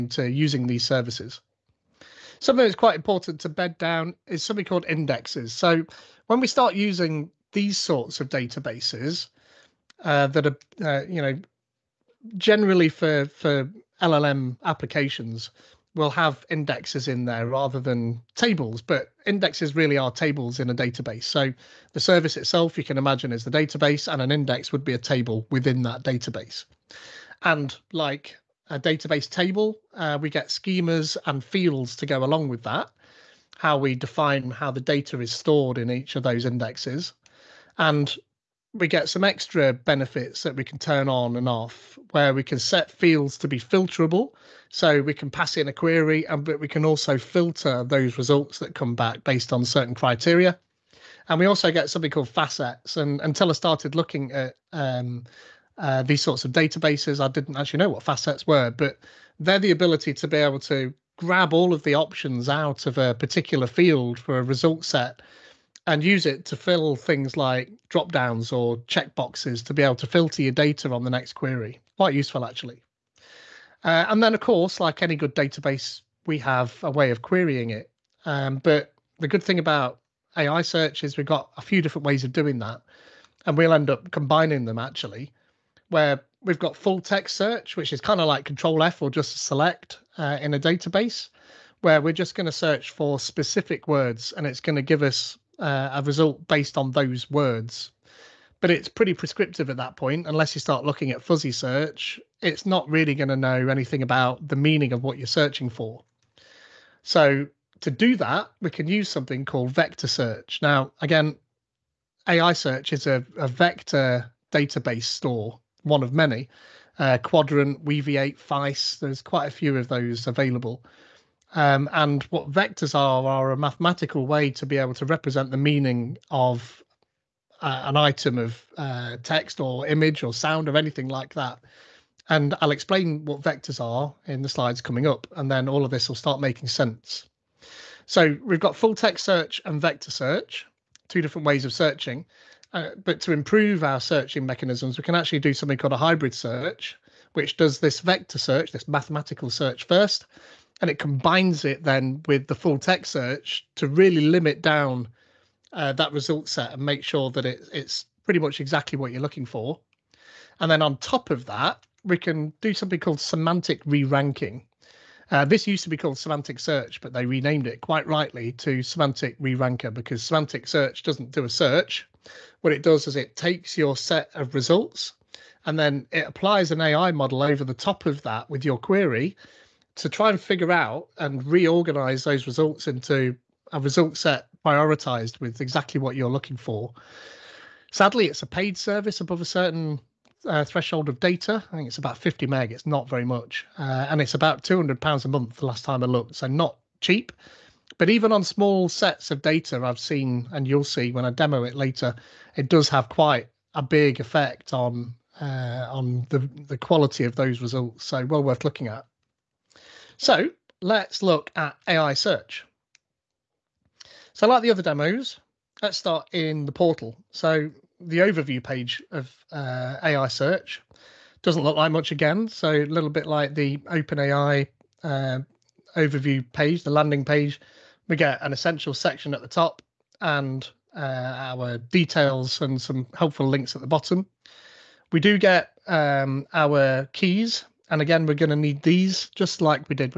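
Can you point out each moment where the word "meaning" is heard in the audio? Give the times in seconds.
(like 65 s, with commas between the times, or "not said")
104 s, 125 s.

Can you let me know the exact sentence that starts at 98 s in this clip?
But it's pretty prescriptive at that point, unless you start looking at fuzzy search.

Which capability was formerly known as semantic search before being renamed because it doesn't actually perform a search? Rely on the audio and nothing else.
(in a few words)
Semantic re-ranker.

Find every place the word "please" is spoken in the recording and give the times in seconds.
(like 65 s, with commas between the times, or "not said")
not said.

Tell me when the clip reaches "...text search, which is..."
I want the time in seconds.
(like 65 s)
87 s.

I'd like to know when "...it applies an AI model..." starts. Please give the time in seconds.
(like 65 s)
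176 s.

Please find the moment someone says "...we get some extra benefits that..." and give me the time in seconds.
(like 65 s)
38 s.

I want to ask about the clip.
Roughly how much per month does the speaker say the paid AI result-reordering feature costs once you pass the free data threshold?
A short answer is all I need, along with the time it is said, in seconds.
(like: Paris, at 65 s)
200 pounds, at 194 s.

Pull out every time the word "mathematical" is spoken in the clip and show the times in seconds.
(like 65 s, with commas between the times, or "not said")
123 s, 148 s.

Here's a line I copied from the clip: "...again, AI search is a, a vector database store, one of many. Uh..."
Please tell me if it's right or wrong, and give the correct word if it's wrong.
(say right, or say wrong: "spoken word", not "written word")
right.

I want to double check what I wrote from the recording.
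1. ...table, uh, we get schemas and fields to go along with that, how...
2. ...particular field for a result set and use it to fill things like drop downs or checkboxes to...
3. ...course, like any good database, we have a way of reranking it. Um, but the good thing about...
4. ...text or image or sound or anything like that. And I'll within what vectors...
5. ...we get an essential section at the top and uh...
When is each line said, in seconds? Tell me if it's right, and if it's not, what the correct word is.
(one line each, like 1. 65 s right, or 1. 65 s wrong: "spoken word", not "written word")
1. 29 s right
2. 63 s right
3. 74 s wrong: "querying", not "reranking"
4. 129 s wrong: "explain", not "within"
5. 228 s right.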